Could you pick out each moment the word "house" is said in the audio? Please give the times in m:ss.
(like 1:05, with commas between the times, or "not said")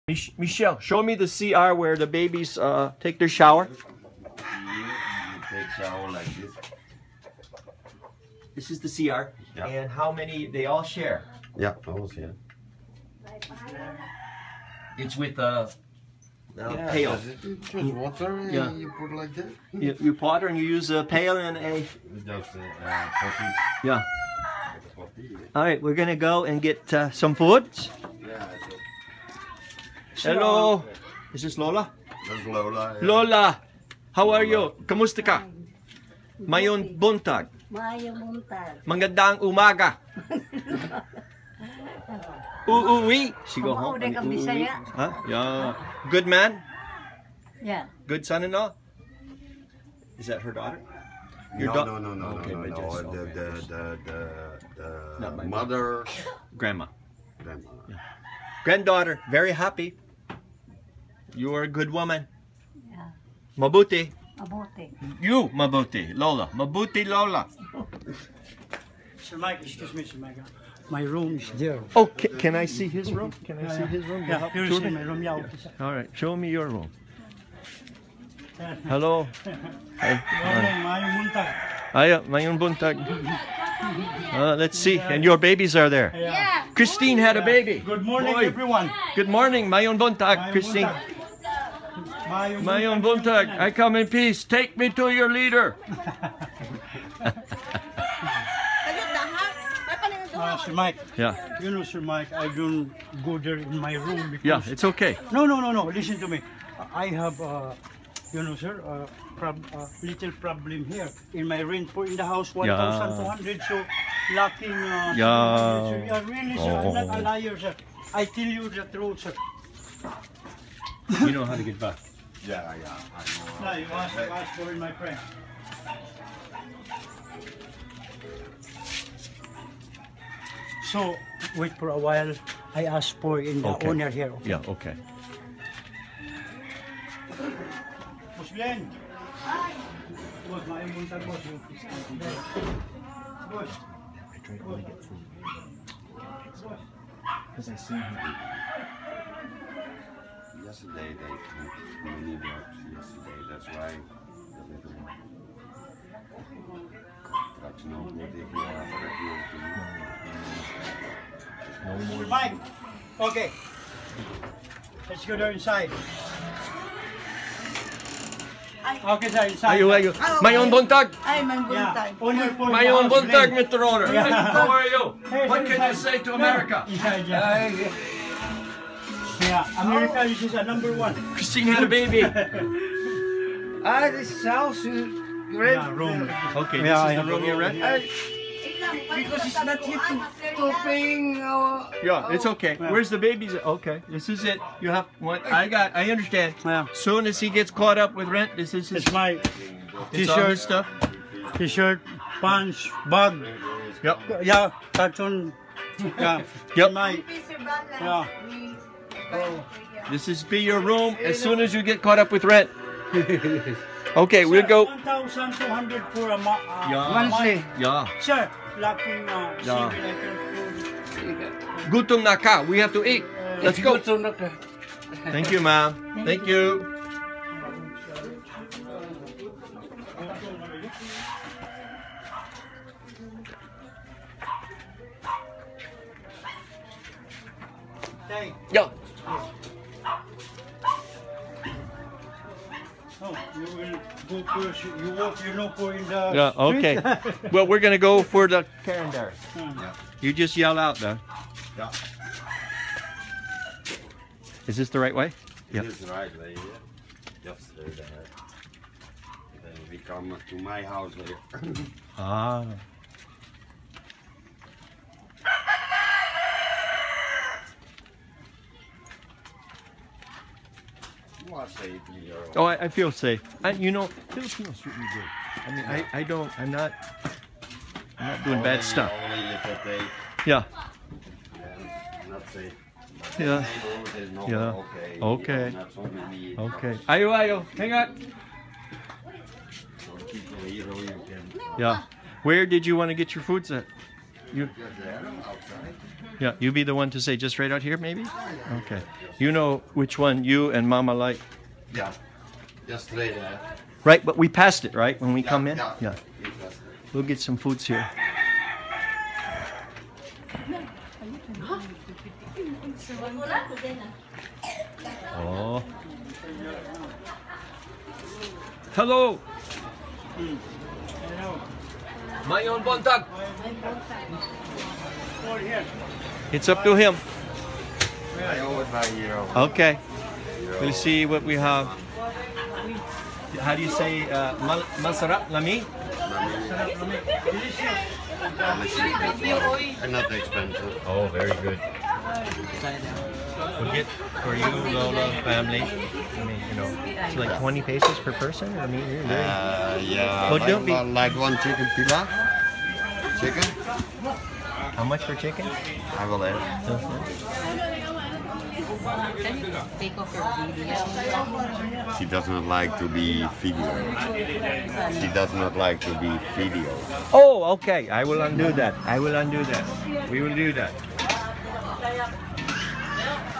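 1:52, 3:04, 4:20.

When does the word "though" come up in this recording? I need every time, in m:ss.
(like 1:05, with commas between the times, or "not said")
4:10.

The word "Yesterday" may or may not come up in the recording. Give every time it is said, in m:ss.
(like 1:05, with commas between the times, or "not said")
2:30.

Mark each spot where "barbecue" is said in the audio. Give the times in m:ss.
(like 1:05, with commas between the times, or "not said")
not said.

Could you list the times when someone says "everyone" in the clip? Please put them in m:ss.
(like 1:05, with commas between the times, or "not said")
1:28.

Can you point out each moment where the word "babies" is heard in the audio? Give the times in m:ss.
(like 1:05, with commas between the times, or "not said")
0:02, 1:25.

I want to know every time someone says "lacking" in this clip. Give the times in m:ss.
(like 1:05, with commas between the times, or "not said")
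1:54.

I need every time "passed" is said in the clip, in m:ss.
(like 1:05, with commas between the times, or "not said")
5:04.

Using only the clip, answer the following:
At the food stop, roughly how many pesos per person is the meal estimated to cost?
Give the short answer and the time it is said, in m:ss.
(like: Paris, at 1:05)
20 pesos, at 5:47.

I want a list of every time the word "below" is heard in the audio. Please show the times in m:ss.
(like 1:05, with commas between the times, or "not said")
not said.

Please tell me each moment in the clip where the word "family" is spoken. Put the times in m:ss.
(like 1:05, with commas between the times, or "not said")
5:45.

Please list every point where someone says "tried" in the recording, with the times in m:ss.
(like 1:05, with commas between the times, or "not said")
2:18.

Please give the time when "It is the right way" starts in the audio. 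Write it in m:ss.
4:15.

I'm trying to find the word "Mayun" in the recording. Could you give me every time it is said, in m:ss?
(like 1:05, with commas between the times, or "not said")
1:22, 1:29.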